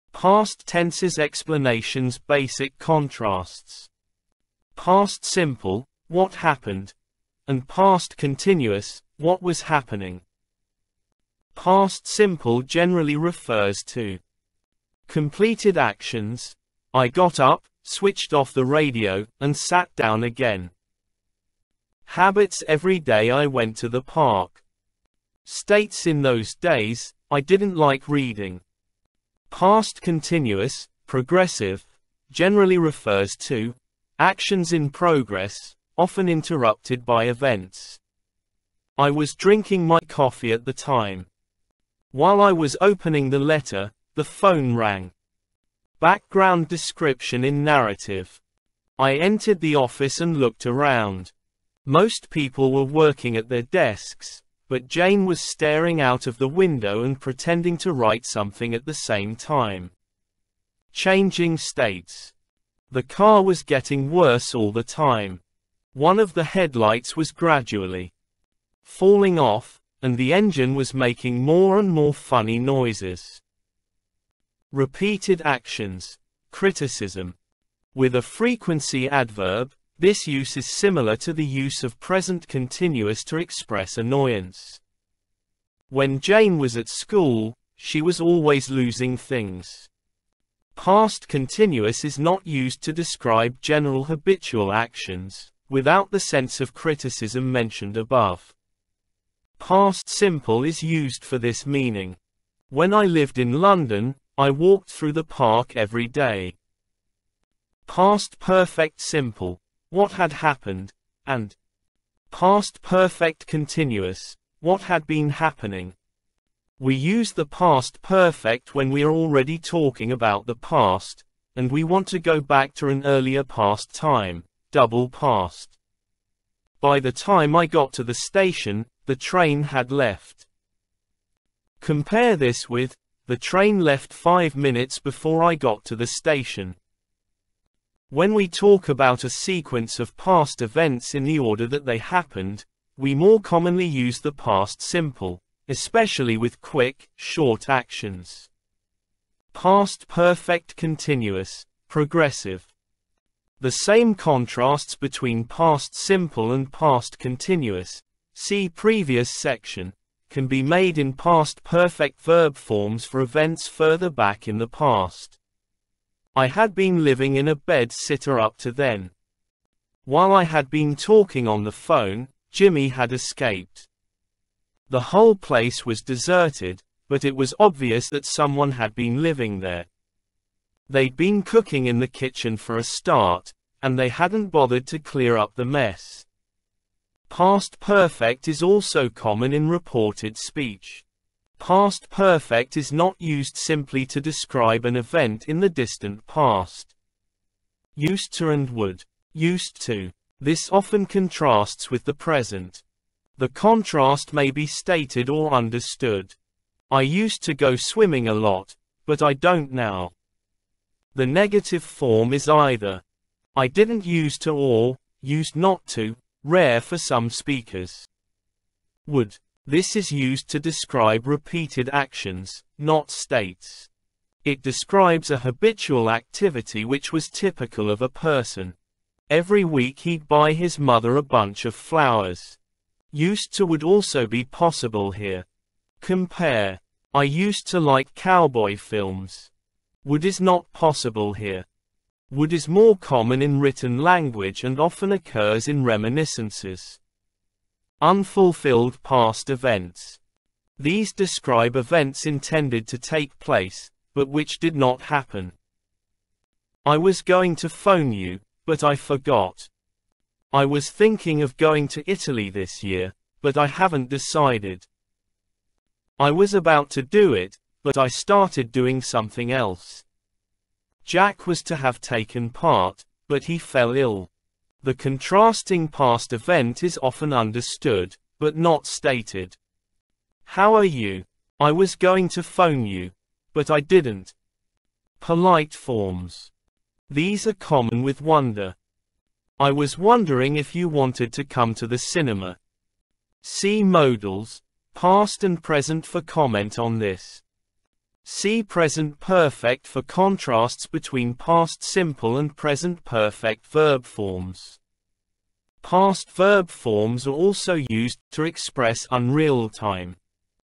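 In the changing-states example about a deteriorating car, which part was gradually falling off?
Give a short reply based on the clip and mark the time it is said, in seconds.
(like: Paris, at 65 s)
One of the headlights, at 65 s.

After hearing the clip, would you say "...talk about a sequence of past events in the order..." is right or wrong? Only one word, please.
right.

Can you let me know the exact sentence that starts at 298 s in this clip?
See present perfect for contrasts between past simple and present perfect verb forms.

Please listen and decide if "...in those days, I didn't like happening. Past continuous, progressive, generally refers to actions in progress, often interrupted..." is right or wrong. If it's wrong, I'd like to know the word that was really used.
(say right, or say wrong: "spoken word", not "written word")
wrong: "reading", not "happening".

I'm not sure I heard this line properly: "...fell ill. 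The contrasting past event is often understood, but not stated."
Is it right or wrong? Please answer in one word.
right.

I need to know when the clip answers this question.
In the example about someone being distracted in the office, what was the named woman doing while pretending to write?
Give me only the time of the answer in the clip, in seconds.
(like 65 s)
55 s.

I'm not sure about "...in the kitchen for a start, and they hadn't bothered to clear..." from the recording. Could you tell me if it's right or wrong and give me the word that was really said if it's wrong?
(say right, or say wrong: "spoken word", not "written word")
right.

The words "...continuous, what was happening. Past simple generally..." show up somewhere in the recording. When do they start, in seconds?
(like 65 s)
8 s.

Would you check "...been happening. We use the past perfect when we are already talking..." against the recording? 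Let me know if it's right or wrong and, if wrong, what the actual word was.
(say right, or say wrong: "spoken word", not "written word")
right.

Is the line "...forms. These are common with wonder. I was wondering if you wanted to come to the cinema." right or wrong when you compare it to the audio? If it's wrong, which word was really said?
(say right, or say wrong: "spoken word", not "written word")
right.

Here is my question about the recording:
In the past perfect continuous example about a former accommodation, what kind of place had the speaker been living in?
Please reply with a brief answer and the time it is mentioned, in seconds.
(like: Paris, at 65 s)
a bed-sitter, at 167 s.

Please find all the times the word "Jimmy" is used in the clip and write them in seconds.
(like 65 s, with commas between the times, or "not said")
172 s.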